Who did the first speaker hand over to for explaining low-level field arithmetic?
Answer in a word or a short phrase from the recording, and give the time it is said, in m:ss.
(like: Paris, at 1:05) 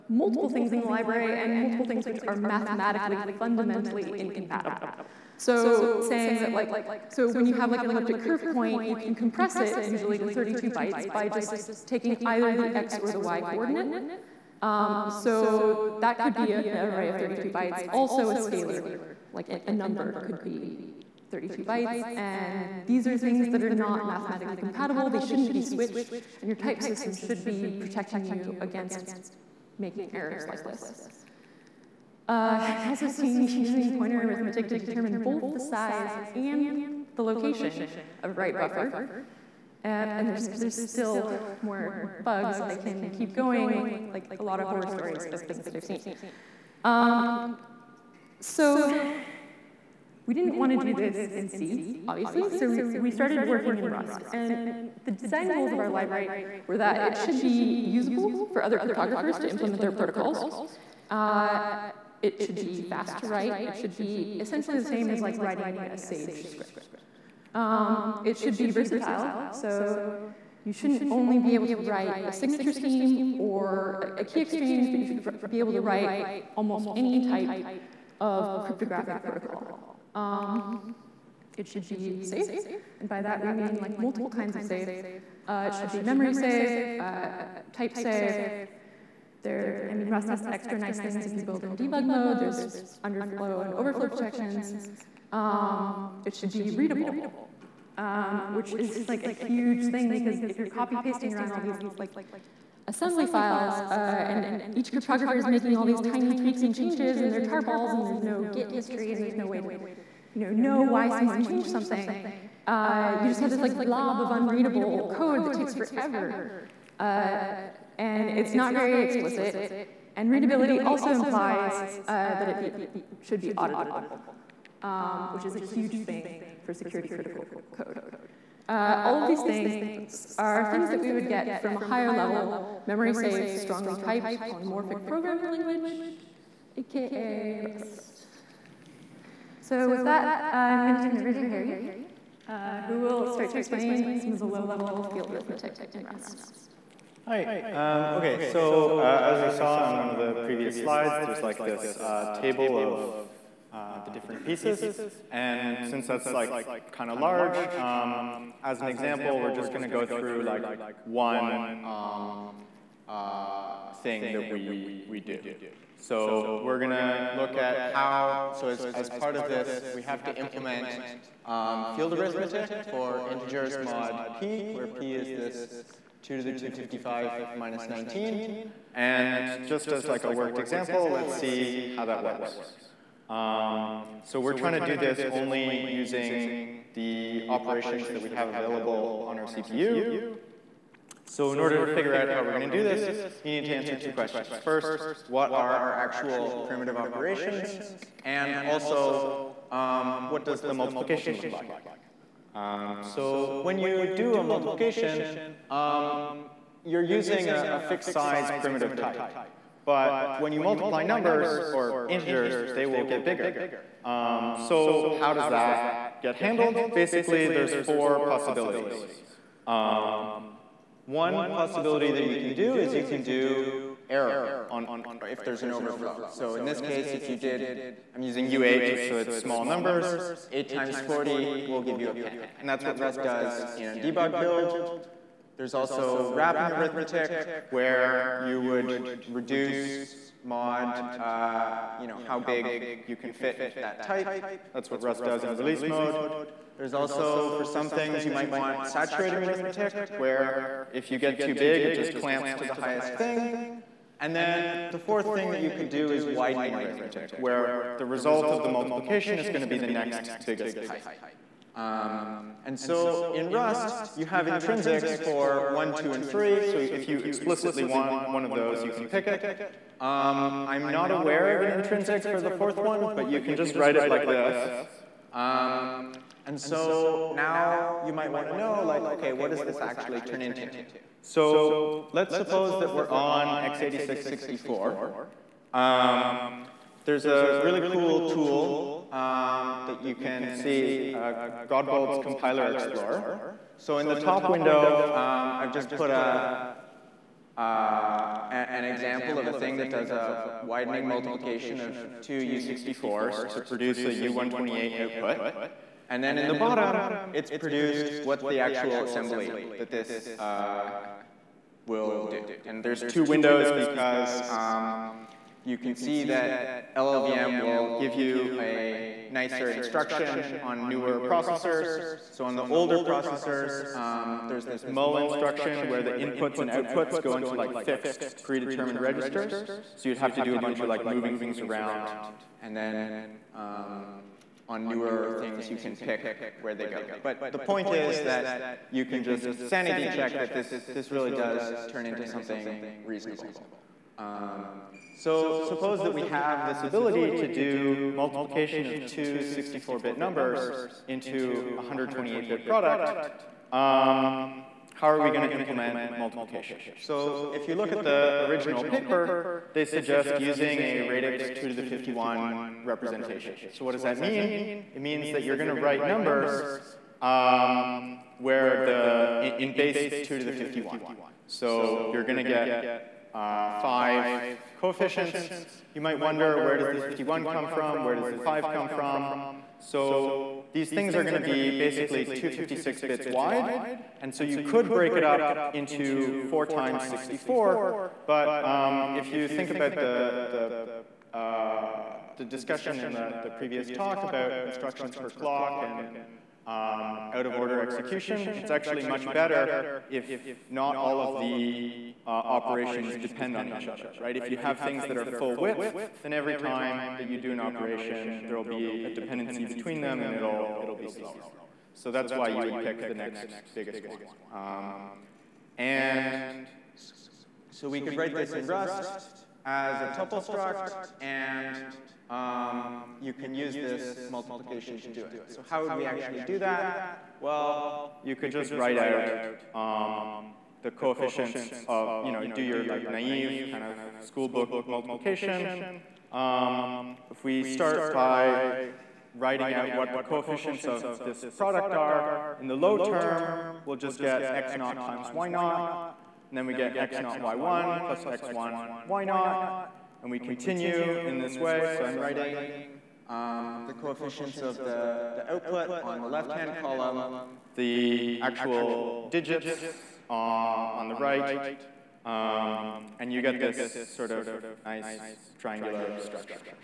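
Harry, at 2:21.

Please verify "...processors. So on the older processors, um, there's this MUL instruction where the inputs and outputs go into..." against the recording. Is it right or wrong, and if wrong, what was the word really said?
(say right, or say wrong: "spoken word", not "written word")
right.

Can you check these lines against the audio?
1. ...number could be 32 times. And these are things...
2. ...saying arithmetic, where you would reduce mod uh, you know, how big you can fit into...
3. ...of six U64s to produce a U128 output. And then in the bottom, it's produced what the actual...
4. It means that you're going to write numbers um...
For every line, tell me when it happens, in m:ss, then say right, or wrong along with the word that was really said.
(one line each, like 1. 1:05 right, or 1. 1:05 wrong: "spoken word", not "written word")
1. 0:19 wrong: "bytes", not "times"
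2. 3:56 wrong: "wrapping", not "saying"
3. 5:01 wrong: "two", not "six"
4. 6:04 right.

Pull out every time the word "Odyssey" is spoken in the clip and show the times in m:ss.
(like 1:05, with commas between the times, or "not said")
not said.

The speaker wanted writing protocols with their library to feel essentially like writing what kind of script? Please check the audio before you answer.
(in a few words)
Sage script.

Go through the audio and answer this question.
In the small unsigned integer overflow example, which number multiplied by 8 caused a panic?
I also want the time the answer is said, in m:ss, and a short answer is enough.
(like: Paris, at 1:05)
40, at 3:51.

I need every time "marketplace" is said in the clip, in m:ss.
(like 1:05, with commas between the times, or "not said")
not said.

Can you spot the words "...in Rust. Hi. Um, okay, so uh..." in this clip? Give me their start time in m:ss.
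2:25.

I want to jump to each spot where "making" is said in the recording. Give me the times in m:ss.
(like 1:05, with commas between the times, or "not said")
0:29, 1:45.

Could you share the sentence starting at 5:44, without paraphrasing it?
Um, so suppose that we have this ability to do multiplication of two 64-bit numbers into a 128-bit product.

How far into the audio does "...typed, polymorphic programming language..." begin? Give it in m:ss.
2:13.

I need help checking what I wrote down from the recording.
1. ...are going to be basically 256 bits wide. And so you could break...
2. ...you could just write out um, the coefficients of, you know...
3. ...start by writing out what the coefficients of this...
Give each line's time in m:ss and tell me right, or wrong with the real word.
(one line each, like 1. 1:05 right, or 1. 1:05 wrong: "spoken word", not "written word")
1. 6:21 right
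2. 7:08 right
3. 7:17 right.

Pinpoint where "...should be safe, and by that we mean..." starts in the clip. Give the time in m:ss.
1:21.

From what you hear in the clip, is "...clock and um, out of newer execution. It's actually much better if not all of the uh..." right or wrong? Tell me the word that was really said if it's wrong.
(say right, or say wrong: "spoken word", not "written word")
wrong: "order", not "newer".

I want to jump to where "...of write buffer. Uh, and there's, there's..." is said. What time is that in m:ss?
0:38.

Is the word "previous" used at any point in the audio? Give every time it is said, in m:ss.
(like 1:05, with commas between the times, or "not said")
2:30, 6:33.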